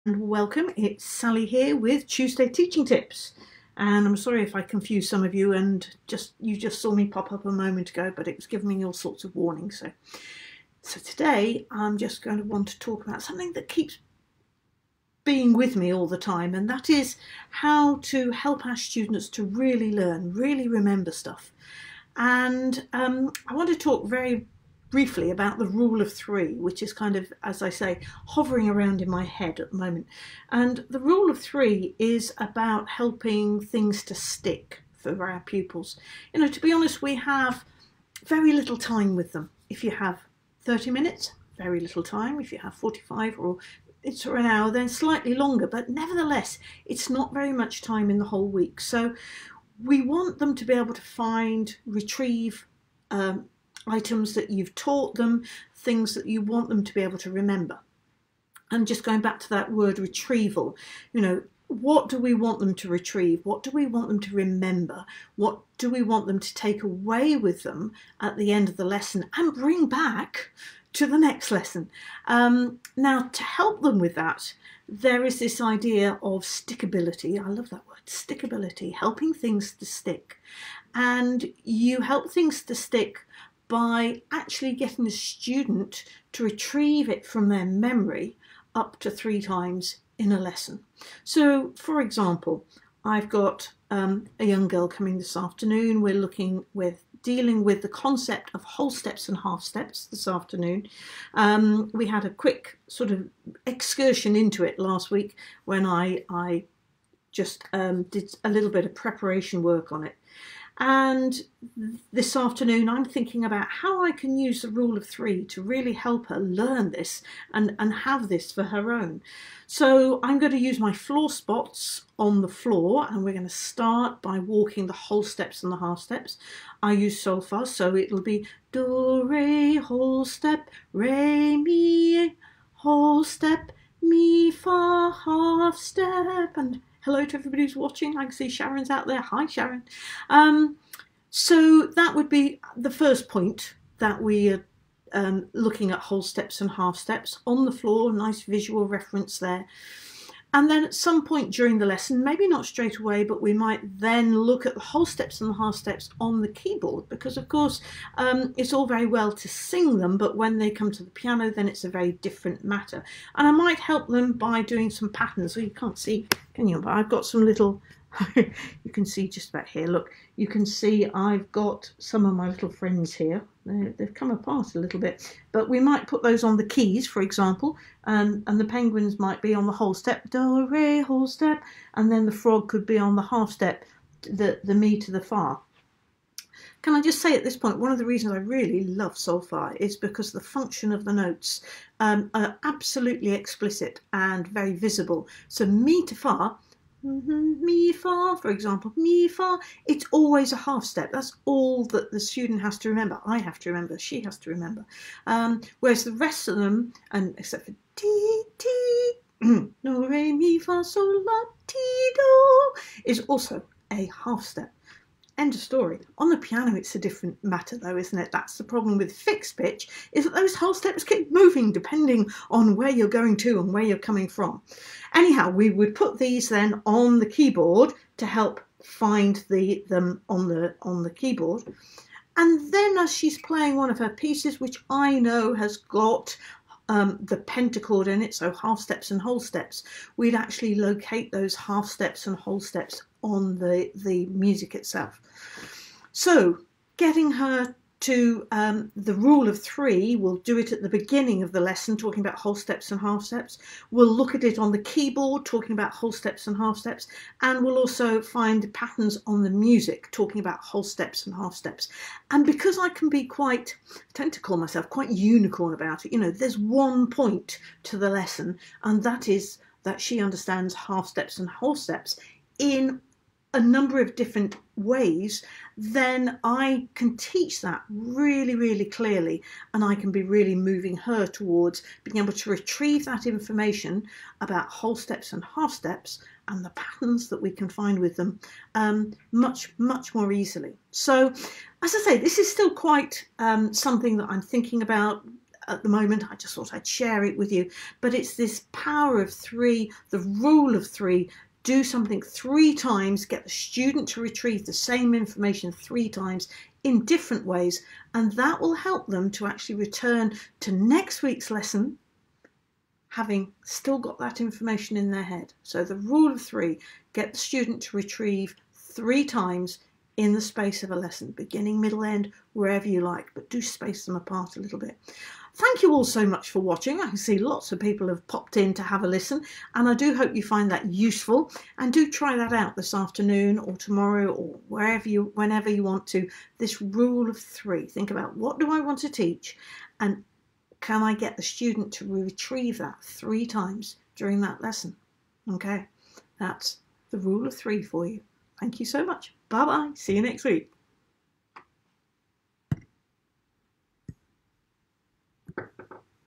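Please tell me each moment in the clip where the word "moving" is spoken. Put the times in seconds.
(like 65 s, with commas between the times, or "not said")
221 s, 280 s.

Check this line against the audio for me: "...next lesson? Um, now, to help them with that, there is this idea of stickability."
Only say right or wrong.
right.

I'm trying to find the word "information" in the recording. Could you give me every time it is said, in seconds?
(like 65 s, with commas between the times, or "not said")
283 s, 305 s, 314 s.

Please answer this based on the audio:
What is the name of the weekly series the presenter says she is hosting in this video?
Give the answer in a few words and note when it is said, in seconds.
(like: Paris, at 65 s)
Tuesday Teaching Tips, at 2 s.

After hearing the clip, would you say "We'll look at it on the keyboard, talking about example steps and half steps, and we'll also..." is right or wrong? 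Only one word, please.
wrong.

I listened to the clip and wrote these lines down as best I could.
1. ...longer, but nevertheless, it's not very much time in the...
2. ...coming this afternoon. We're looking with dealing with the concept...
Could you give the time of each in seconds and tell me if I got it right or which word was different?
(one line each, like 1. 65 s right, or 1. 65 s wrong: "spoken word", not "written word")
1. 45 s right
2. 94 s right.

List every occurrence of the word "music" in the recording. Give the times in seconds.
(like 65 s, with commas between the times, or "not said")
244 s, 259 s.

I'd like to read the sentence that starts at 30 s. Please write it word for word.
And the rule of three is about helping things to stick for our pupils.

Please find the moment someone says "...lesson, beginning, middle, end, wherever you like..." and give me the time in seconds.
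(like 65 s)
320 s.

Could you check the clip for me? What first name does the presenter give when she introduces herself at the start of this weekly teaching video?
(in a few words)
Sally.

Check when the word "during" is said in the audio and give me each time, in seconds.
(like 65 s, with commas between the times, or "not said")
151 s, 344 s.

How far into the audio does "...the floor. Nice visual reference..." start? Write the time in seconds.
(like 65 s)
147 s.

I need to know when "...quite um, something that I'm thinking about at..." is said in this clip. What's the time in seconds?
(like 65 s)
292 s.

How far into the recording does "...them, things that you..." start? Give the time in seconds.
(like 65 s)
55 s.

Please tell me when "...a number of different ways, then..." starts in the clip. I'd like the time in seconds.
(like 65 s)
273 s.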